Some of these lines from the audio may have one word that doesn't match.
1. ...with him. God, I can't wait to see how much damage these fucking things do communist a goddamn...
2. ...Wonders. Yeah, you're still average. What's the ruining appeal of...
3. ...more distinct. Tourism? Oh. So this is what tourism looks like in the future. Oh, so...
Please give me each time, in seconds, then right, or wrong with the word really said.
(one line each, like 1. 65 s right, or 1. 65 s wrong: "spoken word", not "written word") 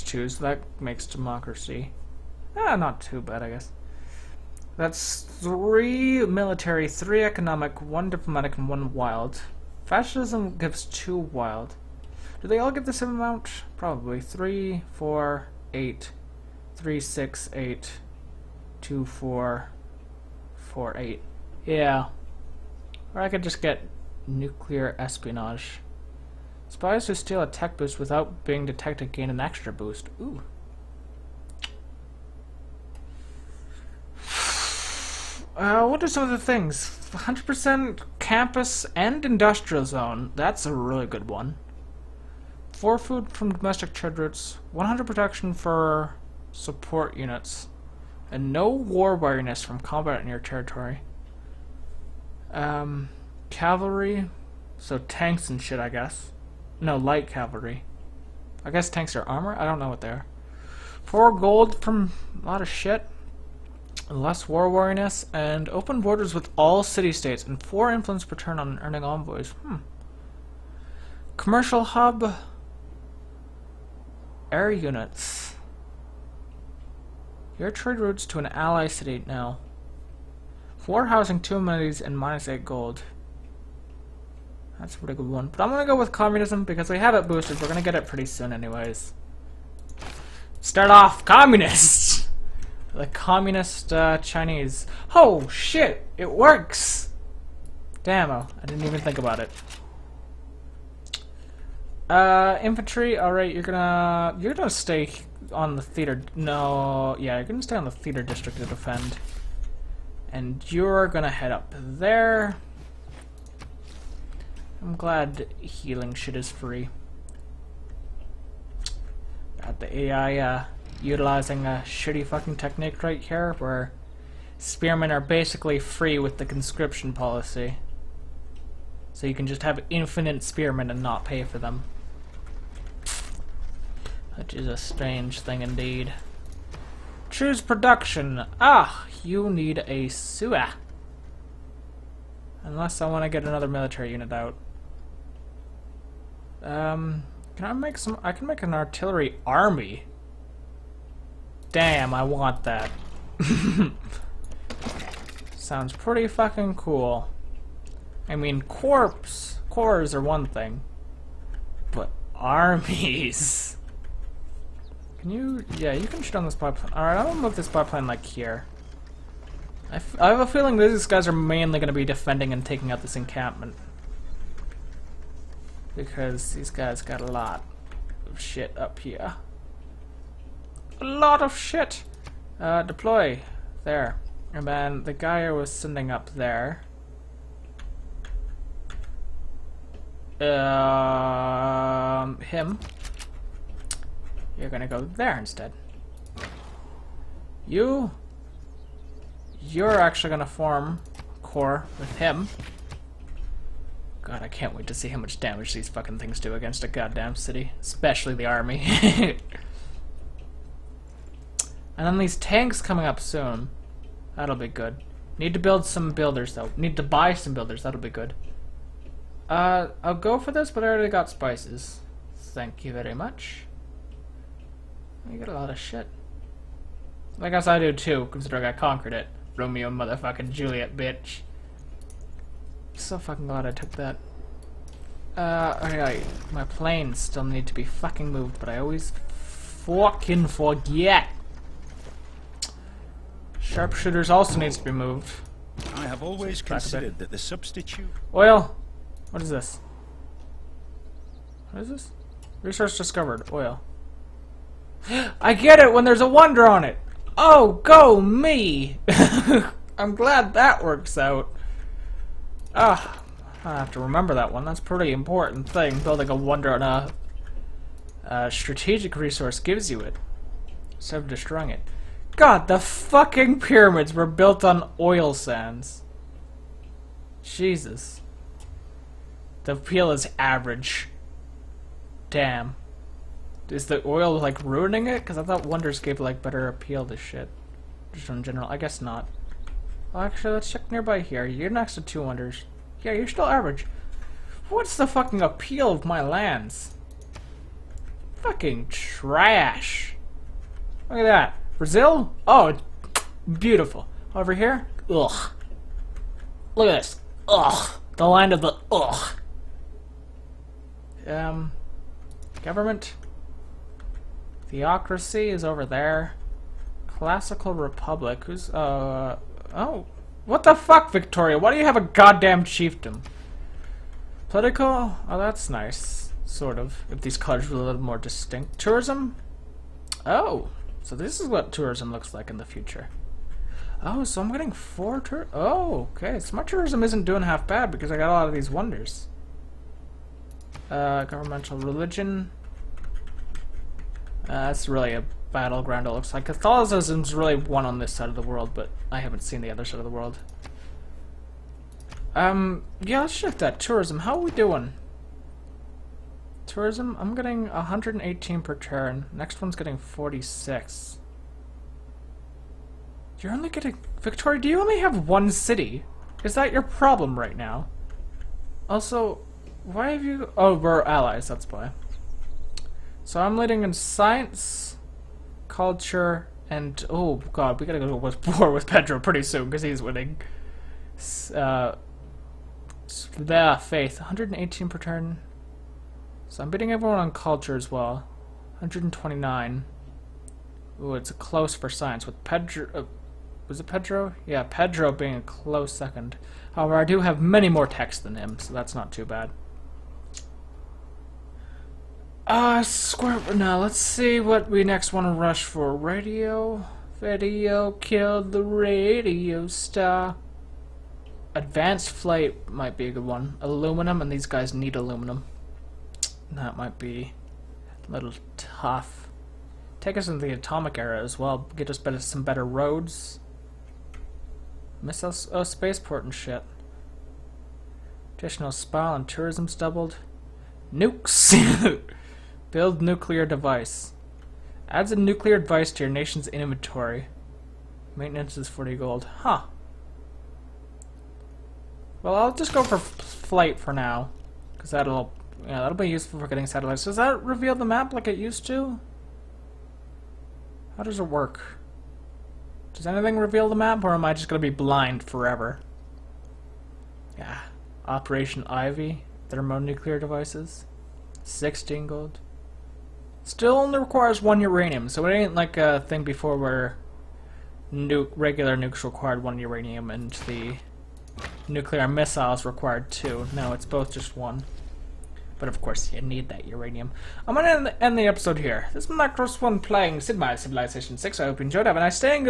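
1. 201 s wrong: "against", not "communist"
2. 292 s wrong: "fucking", not "ruining"
3. 328 s right.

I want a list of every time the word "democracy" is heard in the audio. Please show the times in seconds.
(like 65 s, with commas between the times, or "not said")
1 s.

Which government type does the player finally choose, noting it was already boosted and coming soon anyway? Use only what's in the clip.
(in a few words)
Communism.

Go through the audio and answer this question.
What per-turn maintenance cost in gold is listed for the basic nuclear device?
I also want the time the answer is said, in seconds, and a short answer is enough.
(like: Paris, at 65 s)
40 gold, at 438 s.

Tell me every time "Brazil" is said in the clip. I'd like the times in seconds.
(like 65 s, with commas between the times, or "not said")
301 s.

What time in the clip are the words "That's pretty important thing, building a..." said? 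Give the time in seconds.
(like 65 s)
264 s.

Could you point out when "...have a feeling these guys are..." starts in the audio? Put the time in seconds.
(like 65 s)
170 s.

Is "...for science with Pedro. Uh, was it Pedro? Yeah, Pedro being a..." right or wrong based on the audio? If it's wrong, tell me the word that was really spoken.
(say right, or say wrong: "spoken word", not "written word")
right.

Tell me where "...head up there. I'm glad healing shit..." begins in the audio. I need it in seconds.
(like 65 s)
111 s.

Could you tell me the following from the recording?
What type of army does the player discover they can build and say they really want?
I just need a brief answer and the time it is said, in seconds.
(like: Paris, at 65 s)
artillery army, at 148 s.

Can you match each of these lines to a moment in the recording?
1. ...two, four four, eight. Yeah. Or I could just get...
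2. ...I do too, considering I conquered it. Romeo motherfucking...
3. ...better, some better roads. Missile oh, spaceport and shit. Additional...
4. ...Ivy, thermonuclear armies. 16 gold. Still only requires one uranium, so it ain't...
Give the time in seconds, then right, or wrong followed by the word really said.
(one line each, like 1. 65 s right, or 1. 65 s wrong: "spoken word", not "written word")
1. 18 s right
2. 227 s right
3. 421 s right
4. 458 s wrong: "devices", not "armies".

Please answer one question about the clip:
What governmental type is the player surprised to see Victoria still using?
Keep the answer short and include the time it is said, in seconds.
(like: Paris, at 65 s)
Chiefdom, at 322 s.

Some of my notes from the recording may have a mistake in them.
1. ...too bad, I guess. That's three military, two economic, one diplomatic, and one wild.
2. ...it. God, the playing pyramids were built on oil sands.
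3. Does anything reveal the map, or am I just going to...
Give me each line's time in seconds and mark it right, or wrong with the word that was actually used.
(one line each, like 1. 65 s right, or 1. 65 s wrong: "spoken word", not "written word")
1. 3 s wrong: "three", not "two"
2. 271 s wrong: "fucking", not "playing"
3. 452 s right.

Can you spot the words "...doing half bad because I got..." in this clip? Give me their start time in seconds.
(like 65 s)
337 s.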